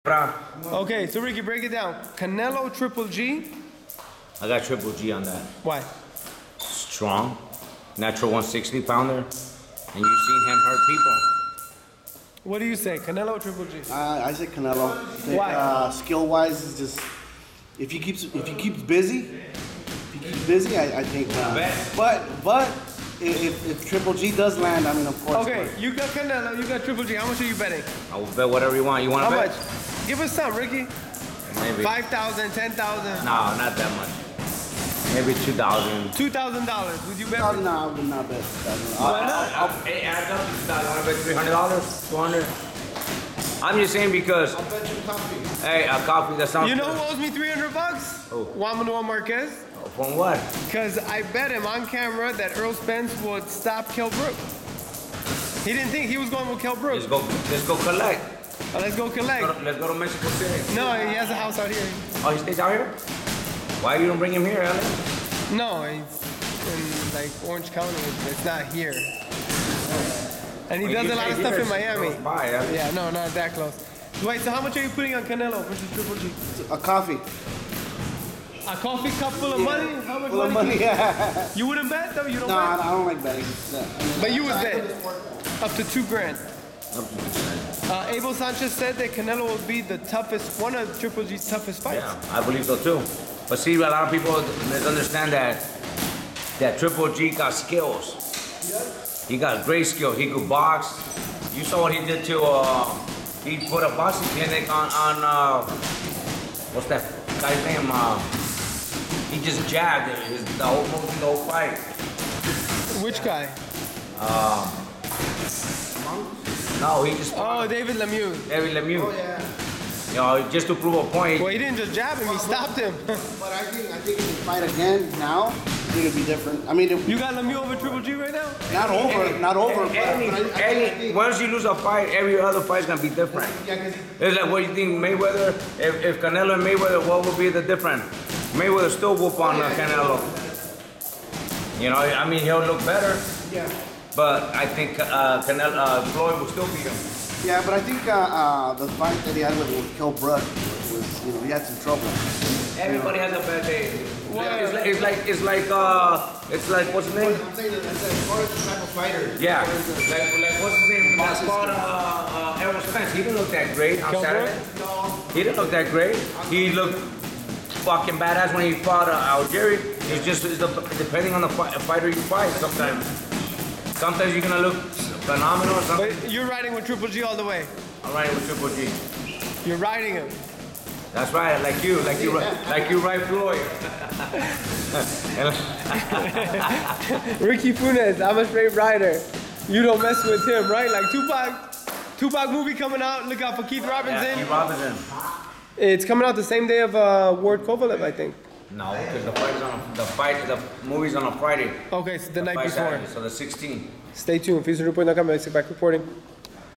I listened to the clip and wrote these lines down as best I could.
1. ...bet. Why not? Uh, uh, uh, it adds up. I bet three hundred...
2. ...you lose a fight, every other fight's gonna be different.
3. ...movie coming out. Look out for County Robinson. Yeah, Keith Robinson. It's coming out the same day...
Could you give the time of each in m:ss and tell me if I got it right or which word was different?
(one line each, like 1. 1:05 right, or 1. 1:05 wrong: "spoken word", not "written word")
1. 0:38 right
2. 2:11 right
3. 3:12 wrong: "Keith", not "County".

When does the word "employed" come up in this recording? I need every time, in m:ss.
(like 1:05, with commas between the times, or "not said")
not said.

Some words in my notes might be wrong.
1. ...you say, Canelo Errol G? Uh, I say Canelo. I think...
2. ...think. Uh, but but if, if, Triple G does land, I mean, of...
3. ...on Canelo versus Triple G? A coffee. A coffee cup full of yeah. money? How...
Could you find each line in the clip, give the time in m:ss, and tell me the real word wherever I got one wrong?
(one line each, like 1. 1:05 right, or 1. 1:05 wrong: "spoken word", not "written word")
1. 0:12 wrong: "Triple", not "Errol"
2. 0:21 right
3. 1:15 right.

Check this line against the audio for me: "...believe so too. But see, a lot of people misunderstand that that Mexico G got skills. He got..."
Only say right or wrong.
wrong.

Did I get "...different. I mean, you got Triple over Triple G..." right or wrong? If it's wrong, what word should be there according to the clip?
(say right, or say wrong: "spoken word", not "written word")
wrong: "Lemieux", not "Triple".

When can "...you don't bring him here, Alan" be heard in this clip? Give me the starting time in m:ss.
1:03.